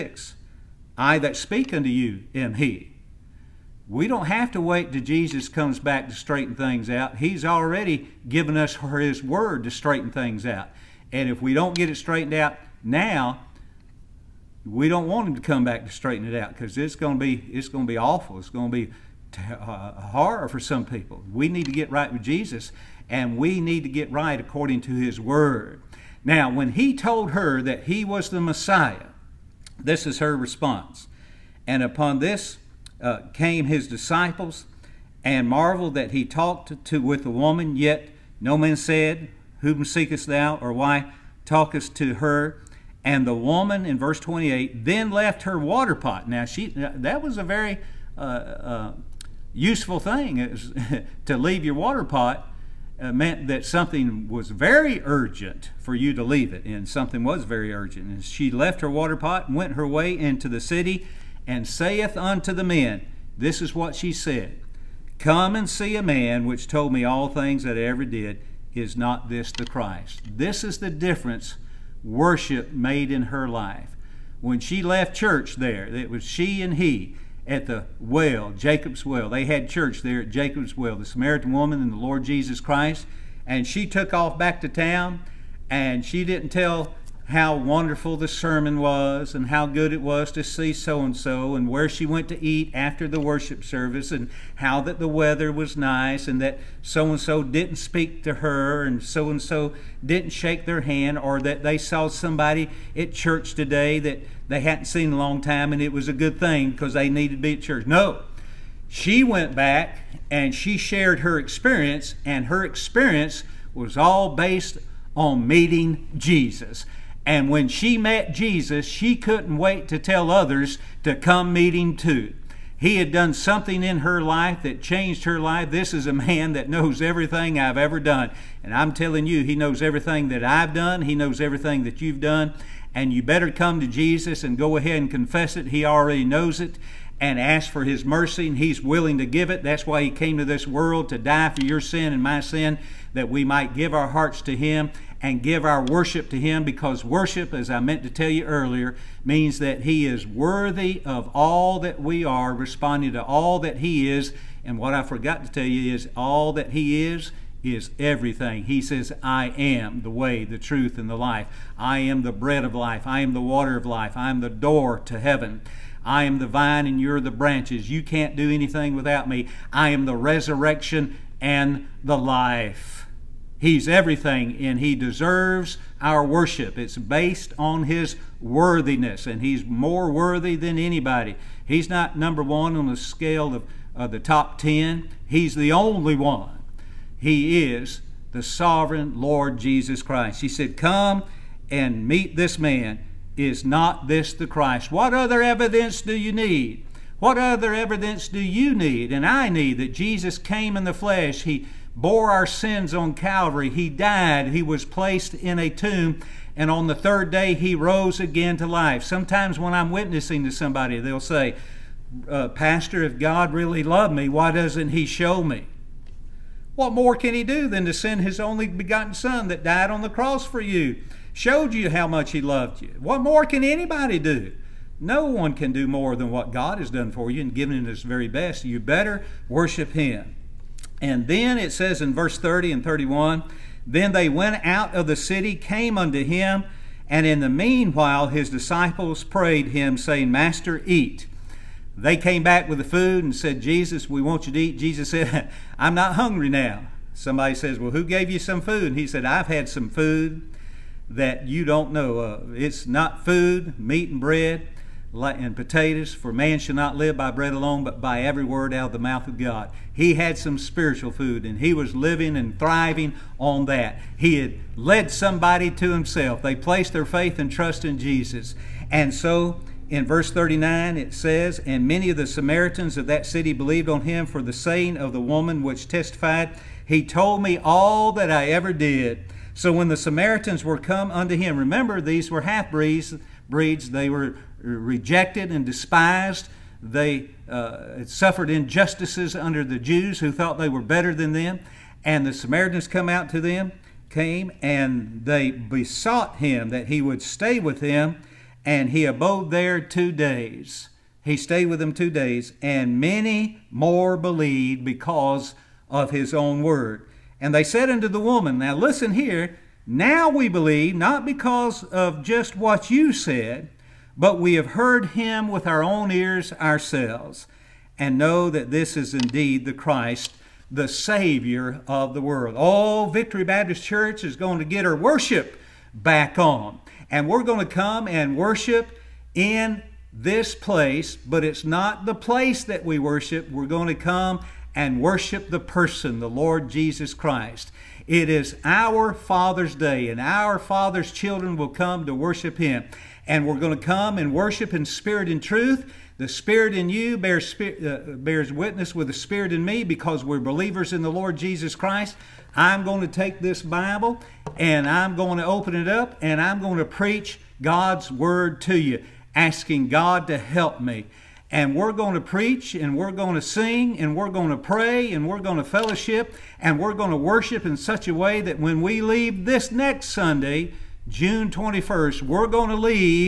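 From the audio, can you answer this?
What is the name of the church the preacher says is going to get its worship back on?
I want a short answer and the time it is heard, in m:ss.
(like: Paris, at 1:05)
Victory Baptist Church, at 5:23.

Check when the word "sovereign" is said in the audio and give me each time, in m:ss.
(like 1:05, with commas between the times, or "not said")
3:08.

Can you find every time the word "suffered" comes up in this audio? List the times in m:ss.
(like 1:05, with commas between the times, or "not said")
4:48.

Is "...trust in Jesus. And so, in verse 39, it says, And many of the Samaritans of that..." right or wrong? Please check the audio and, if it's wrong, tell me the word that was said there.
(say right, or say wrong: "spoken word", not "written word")
right.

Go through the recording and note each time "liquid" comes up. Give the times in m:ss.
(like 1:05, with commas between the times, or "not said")
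not said.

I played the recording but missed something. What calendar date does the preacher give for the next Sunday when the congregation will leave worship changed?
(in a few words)
June 21st.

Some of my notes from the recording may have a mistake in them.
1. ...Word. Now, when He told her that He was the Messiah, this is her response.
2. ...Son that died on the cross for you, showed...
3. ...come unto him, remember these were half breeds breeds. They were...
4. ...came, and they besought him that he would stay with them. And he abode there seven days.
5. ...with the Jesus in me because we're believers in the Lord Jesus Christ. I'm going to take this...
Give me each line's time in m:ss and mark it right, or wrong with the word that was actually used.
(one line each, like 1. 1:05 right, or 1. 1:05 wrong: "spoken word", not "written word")
1. 0:25 right
2. 3:39 right
3. 4:40 right
4. 4:54 wrong: "two", not "seven"
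5. 5:48 wrong: "Spirit", not "Jesus".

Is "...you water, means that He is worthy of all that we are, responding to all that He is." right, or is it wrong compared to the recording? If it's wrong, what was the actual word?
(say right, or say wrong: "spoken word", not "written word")
wrong: "earlier", not "water".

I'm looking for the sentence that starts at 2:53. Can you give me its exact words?
He's everything and He deserves our worship.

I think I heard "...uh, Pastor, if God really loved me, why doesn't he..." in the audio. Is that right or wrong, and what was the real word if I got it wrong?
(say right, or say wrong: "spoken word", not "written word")
right.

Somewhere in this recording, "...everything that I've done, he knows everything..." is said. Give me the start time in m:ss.
2:09.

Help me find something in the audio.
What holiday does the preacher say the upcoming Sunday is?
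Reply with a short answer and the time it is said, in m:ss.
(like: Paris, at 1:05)
Father's Day, at 5:39.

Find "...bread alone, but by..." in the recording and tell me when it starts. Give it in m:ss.
4:17.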